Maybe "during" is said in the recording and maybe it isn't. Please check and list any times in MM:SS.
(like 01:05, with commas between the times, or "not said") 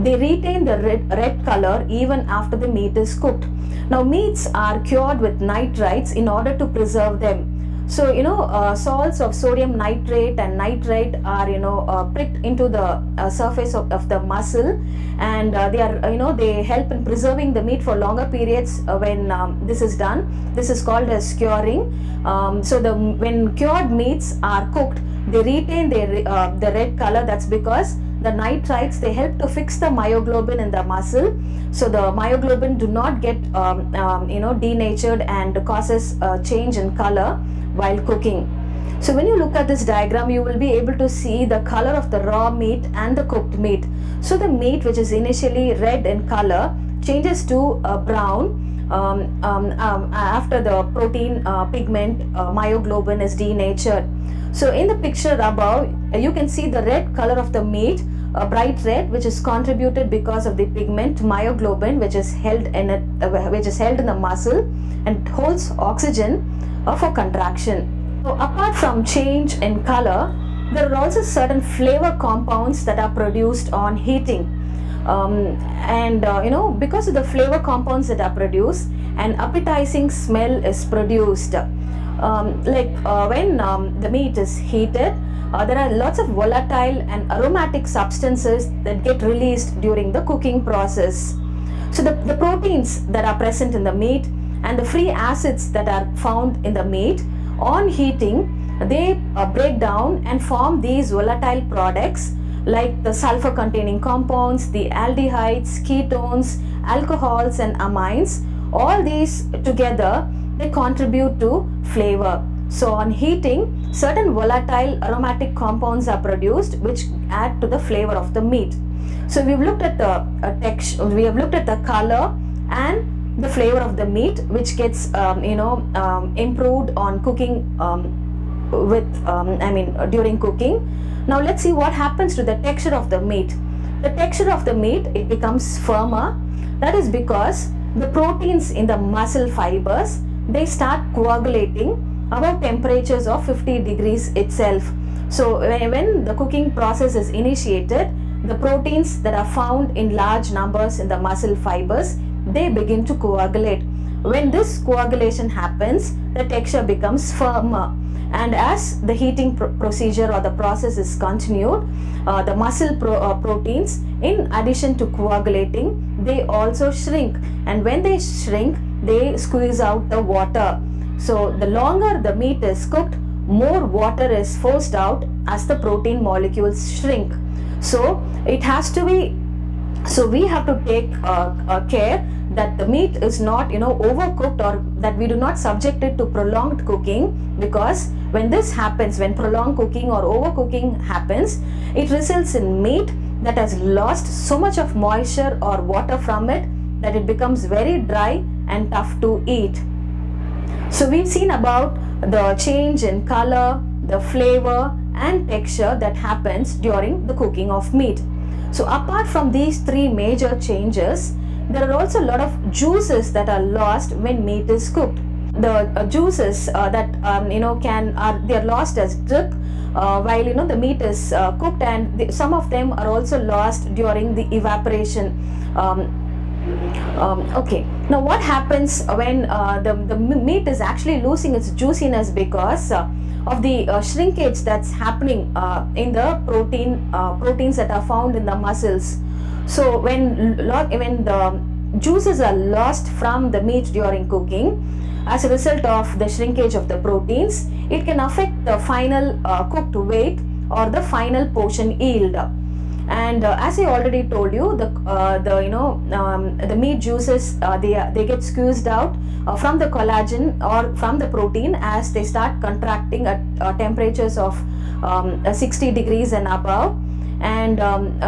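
01:29, 02:10, 03:26, 03:43, 04:03.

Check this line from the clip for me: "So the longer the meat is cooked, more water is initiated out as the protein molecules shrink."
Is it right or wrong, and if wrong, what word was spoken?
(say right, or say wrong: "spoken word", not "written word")
wrong: "forced", not "initiated".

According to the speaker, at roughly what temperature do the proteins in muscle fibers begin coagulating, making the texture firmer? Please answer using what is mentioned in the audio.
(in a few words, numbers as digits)
50 degrees.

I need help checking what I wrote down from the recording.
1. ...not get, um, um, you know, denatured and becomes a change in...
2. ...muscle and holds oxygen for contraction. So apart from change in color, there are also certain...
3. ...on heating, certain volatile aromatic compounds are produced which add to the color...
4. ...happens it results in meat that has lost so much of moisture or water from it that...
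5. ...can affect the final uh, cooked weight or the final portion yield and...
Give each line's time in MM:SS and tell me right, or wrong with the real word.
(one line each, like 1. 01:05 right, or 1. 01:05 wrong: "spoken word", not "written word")
1. 00:32 wrong: "causes", not "becomes"
2. 01:04 right
3. 01:52 wrong: "flavor", not "color"
4. 03:11 right
5. 04:08 right.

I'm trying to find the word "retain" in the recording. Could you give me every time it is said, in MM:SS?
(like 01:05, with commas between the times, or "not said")
00:00, 00:25.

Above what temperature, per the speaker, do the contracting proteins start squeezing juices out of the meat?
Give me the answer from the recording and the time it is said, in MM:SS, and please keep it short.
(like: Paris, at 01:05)
60 degrees, at 04:25.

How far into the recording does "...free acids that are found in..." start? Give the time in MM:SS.
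01:34.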